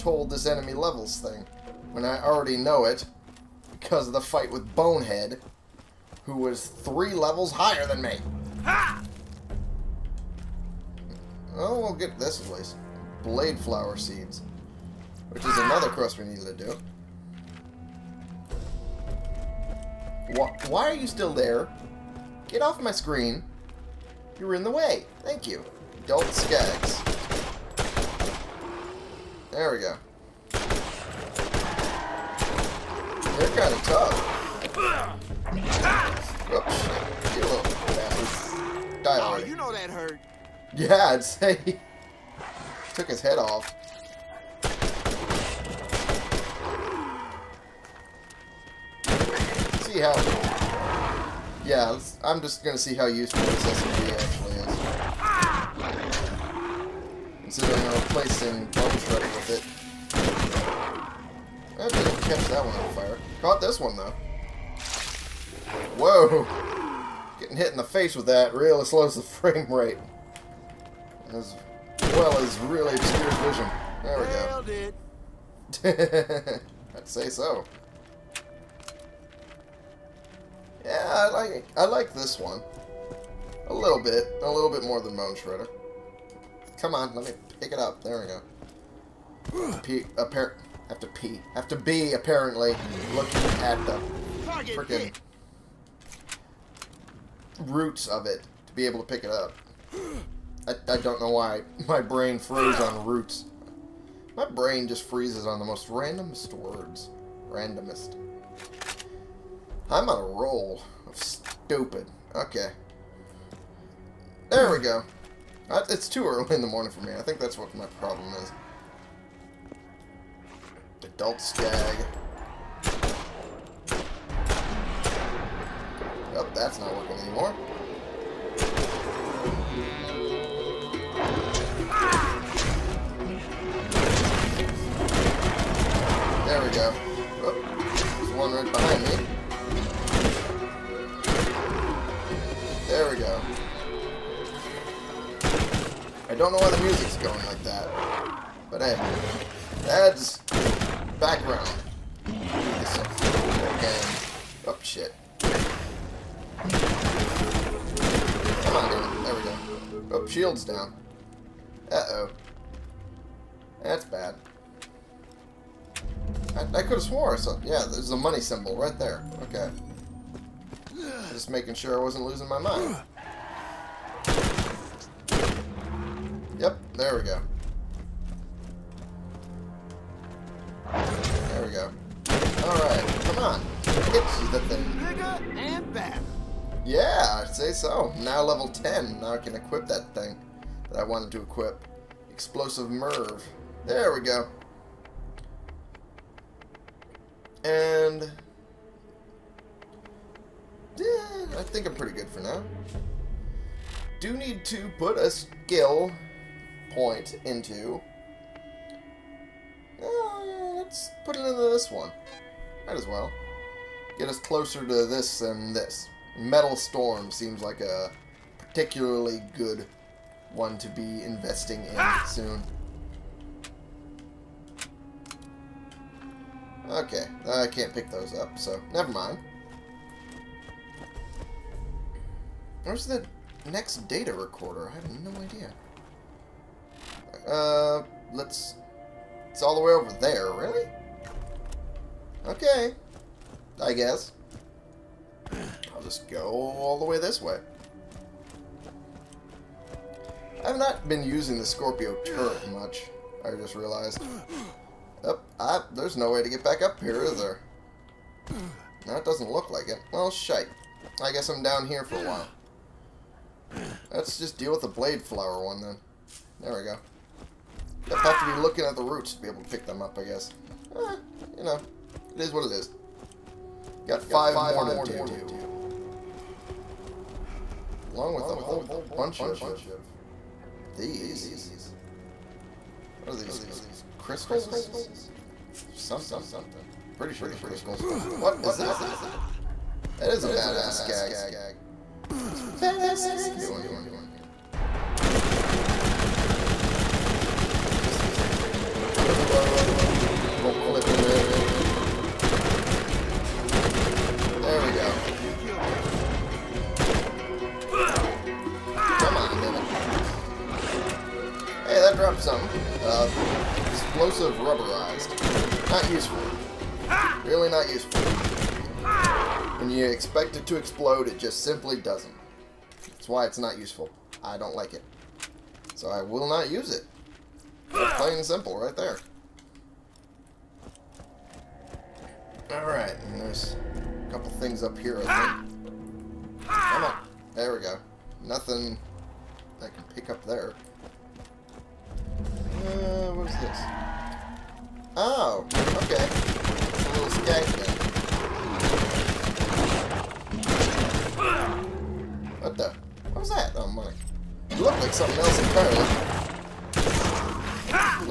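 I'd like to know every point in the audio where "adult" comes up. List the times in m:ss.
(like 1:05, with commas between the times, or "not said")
0:26, 2:01.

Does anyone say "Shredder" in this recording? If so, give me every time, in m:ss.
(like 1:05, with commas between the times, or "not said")
0:58, 1:25.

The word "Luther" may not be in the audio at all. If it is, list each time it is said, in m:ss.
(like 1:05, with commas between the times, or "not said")
not said.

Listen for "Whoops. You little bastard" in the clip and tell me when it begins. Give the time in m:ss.
0:36.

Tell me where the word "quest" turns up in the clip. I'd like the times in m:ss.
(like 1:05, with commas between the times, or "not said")
0:15.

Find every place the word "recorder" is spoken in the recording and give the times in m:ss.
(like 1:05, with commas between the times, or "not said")
3:54.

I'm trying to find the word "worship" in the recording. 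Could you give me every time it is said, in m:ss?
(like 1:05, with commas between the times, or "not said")
not said.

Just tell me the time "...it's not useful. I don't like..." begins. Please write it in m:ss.
5:23.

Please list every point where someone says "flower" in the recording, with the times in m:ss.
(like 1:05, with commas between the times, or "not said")
0:13, 4:25.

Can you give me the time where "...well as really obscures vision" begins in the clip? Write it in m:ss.
1:12.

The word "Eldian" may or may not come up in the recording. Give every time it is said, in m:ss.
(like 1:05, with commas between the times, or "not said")
not said.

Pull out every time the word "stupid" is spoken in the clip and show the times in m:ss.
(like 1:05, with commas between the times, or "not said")
1:51.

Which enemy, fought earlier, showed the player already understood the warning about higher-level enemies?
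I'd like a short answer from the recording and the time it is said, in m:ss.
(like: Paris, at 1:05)
Bonehead, at 0:04.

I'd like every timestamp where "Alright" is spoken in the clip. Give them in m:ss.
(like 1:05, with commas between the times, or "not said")
3:02, 5:32.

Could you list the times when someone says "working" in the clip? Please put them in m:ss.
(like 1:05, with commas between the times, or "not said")
2:06.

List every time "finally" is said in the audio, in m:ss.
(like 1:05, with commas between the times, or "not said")
not said.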